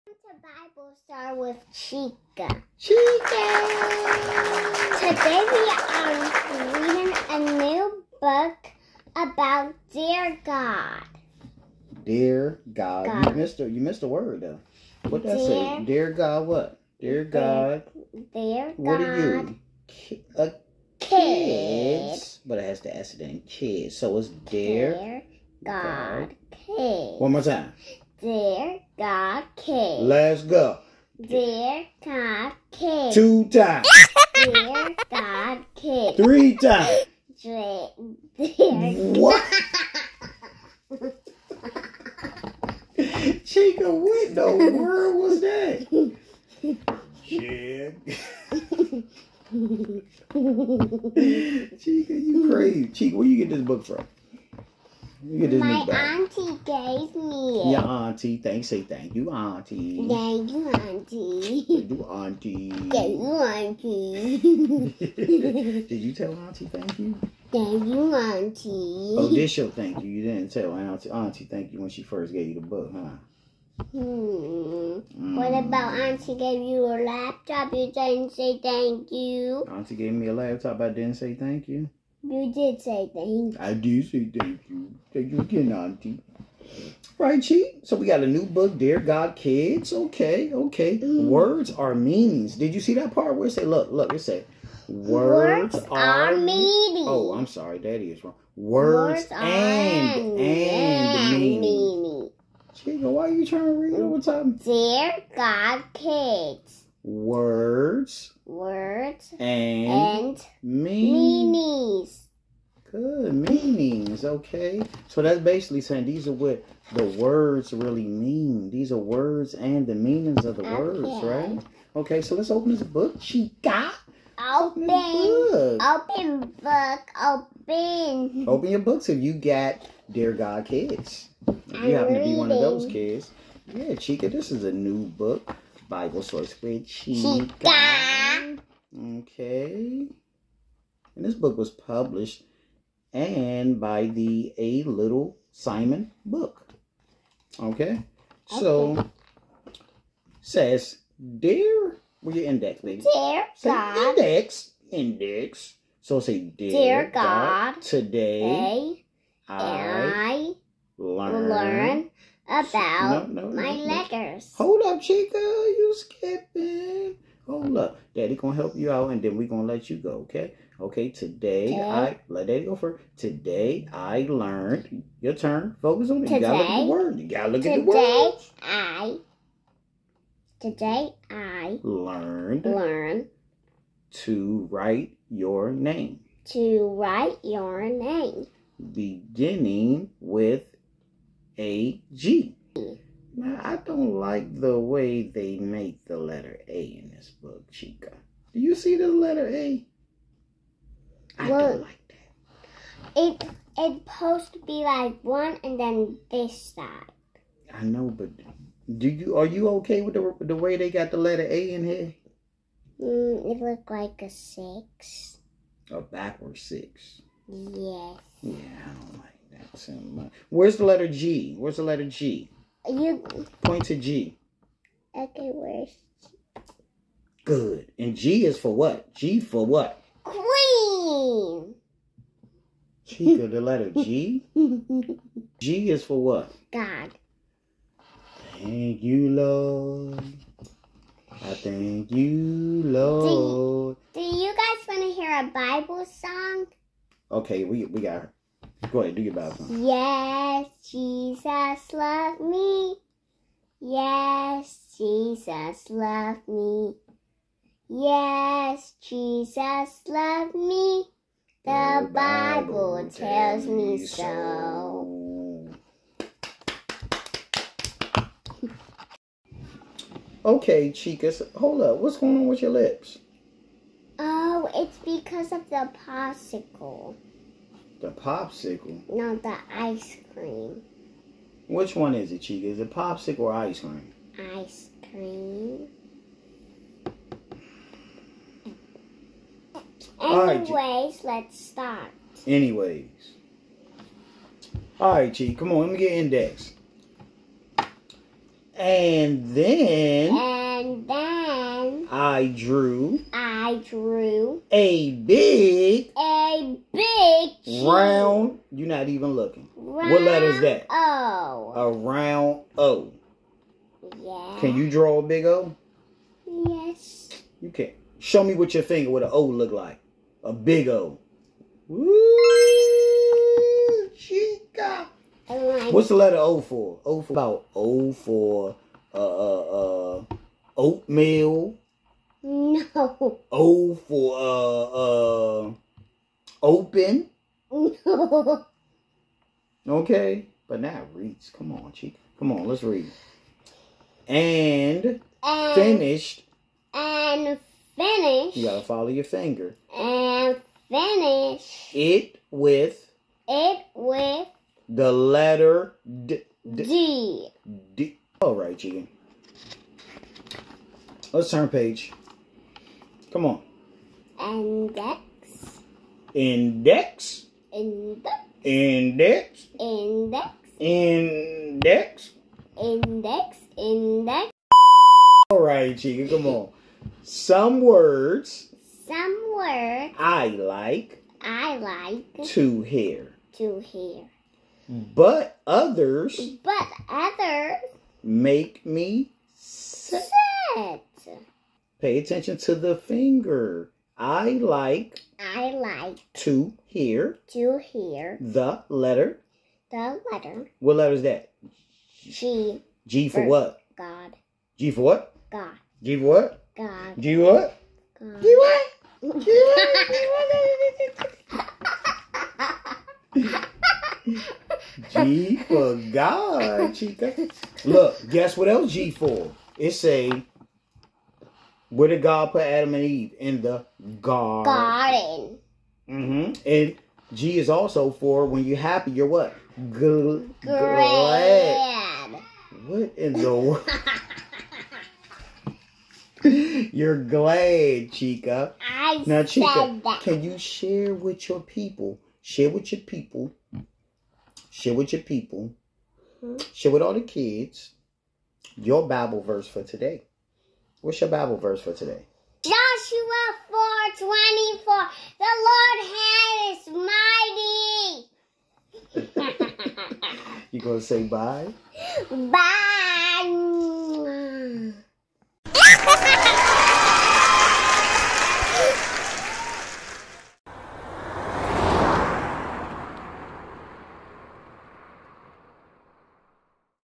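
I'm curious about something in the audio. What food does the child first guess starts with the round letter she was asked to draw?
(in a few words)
Oatmeal.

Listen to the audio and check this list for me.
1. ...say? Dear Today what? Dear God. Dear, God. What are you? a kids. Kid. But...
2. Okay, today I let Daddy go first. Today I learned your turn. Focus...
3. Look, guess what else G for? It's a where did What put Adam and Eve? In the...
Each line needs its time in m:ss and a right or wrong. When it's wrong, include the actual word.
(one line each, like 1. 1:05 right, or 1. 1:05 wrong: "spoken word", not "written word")
1. 0:15 wrong: "God", not "Today"
2. 2:50 right
3. 6:57 wrong: "God", not "What".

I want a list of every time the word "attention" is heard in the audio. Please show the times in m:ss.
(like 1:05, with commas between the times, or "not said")
6:32.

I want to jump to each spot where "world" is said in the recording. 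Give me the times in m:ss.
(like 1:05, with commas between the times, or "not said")
0:44, 7:13.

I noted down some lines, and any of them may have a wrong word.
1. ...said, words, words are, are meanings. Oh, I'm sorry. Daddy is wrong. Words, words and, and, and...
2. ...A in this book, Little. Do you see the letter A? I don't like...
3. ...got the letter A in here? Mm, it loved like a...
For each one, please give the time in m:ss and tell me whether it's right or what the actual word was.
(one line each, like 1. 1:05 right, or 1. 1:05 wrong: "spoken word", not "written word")
1. 1:34 right
2. 3:16 wrong: "Chica", not "Little"
3. 3:30 wrong: "looked", not "loved".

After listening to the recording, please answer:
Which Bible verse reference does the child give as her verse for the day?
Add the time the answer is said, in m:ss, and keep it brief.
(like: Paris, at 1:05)
Joshua 4:24, at 7:32.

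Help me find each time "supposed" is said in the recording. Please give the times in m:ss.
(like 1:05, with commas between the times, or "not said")
3:24.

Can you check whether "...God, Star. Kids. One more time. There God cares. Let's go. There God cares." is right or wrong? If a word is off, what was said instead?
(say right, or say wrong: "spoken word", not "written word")
wrong: "God", not "Star".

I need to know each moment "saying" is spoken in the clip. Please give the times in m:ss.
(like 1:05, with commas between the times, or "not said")
1:55.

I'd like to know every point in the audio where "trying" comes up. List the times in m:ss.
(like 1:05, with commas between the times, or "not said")
1:43.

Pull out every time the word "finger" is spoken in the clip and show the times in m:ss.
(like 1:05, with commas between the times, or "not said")
5:18, 5:49, 6:32.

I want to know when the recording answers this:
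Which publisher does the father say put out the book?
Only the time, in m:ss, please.
2:24.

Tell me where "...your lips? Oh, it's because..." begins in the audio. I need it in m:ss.
4:32.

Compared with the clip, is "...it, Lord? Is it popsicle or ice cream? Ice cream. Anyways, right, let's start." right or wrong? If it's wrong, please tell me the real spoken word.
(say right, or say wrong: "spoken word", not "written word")
wrong: "Chica", not "Lord".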